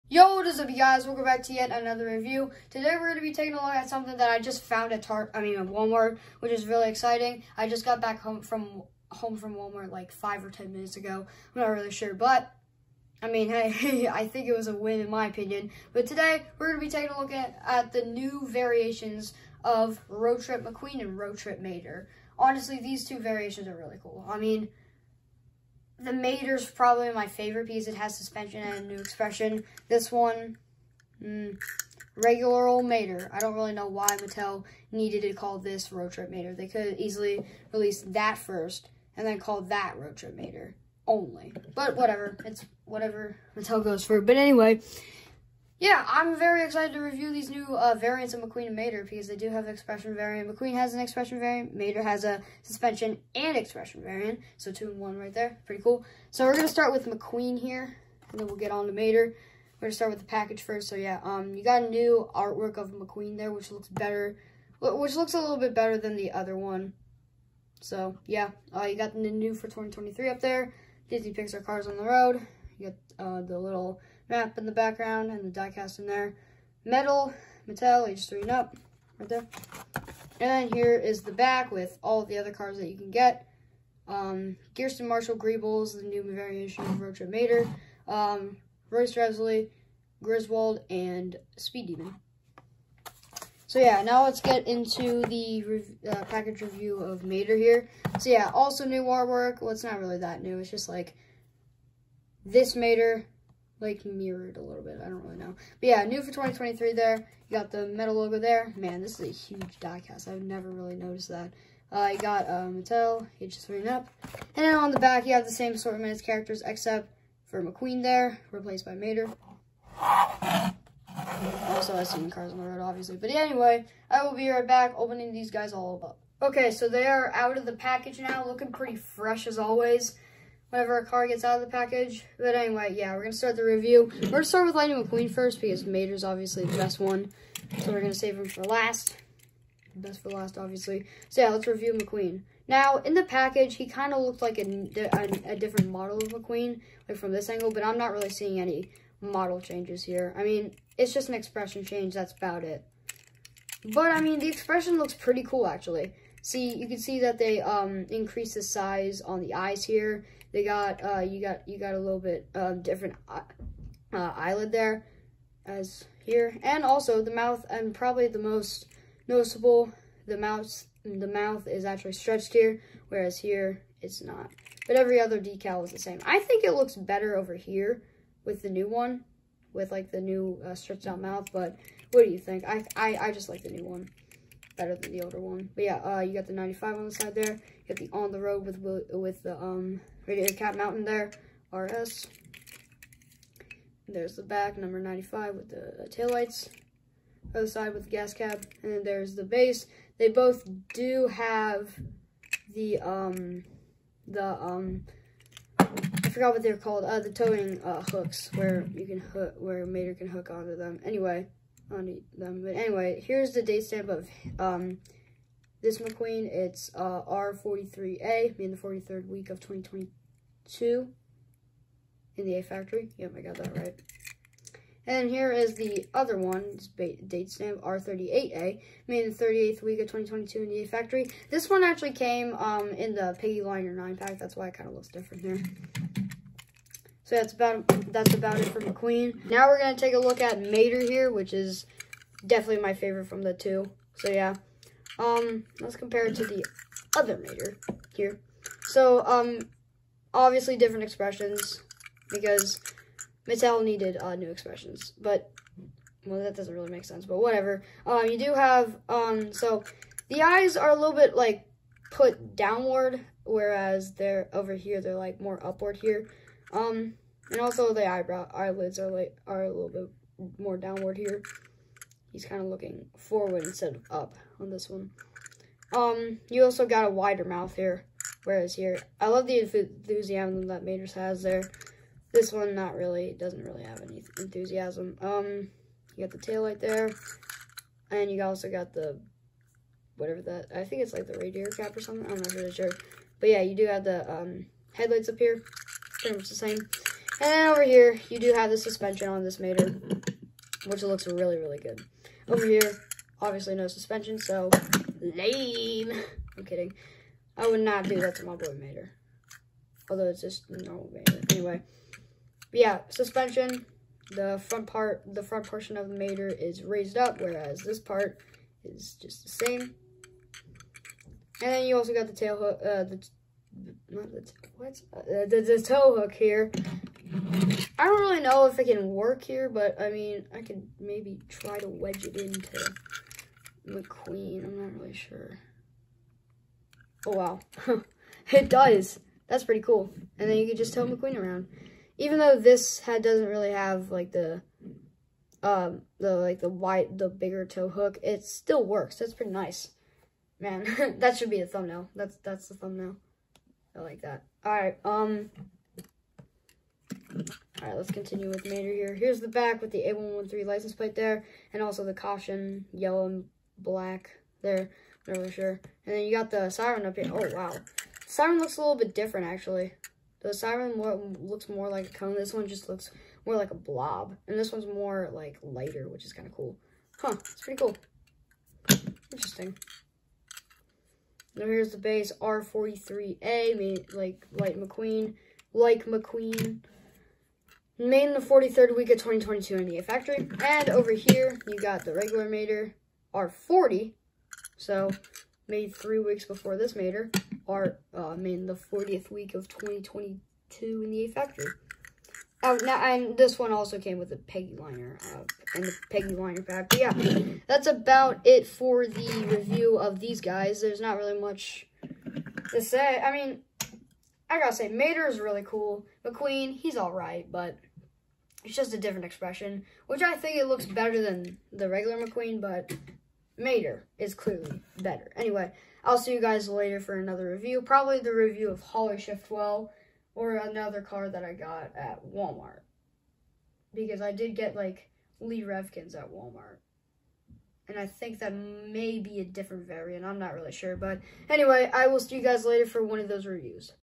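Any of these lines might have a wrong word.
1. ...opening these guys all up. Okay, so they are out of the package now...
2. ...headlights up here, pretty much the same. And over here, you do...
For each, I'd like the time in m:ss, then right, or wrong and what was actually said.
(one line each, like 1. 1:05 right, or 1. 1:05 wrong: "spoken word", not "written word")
1. 2:04 right
2. 4:54 right.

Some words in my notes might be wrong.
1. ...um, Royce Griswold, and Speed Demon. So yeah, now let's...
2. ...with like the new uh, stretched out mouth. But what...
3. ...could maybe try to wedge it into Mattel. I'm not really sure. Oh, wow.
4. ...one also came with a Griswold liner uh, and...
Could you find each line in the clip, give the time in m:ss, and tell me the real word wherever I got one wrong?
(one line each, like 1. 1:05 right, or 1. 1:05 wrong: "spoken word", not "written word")
1. 1:28 right
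2. 2:59 right
3. 5:30 wrong: "McQueen", not "Mattel"
4. 6:43 wrong: "Peggy", not "Griswold".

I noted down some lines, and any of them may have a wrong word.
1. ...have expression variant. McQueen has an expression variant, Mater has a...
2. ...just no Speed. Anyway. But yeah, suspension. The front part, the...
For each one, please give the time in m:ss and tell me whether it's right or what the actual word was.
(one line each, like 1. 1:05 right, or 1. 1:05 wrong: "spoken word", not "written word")
1. 0:49 right
2. 5:10 wrong: "Mater", not "Speed".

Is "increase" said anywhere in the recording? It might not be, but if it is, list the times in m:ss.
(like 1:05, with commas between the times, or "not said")
2:38.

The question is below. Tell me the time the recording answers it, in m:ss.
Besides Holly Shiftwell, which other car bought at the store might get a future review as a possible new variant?
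7:15.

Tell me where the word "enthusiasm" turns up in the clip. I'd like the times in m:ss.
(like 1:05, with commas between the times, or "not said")
4:39, 4:44.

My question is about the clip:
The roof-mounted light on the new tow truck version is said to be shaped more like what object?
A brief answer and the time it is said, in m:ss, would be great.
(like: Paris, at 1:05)
a cone, at 6:11.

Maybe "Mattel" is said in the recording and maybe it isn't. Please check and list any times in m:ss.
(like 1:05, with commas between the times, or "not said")
0:34, 0:43, 1:17, 1:52, 4:13.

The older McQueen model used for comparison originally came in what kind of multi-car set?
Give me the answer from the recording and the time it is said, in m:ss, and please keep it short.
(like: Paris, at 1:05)
Piggy Liner 9-pack, at 3:53.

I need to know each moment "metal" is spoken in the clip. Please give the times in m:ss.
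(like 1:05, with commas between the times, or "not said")
1:16, 1:47.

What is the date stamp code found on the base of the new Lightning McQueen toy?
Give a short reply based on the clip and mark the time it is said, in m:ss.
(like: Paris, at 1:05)
R43A, at 3:36.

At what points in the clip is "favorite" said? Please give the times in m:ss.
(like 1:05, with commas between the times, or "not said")
0:27, 4:02.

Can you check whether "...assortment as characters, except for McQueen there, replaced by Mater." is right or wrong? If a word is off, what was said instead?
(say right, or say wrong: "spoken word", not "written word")
right.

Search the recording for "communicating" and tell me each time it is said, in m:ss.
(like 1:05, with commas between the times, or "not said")
not said.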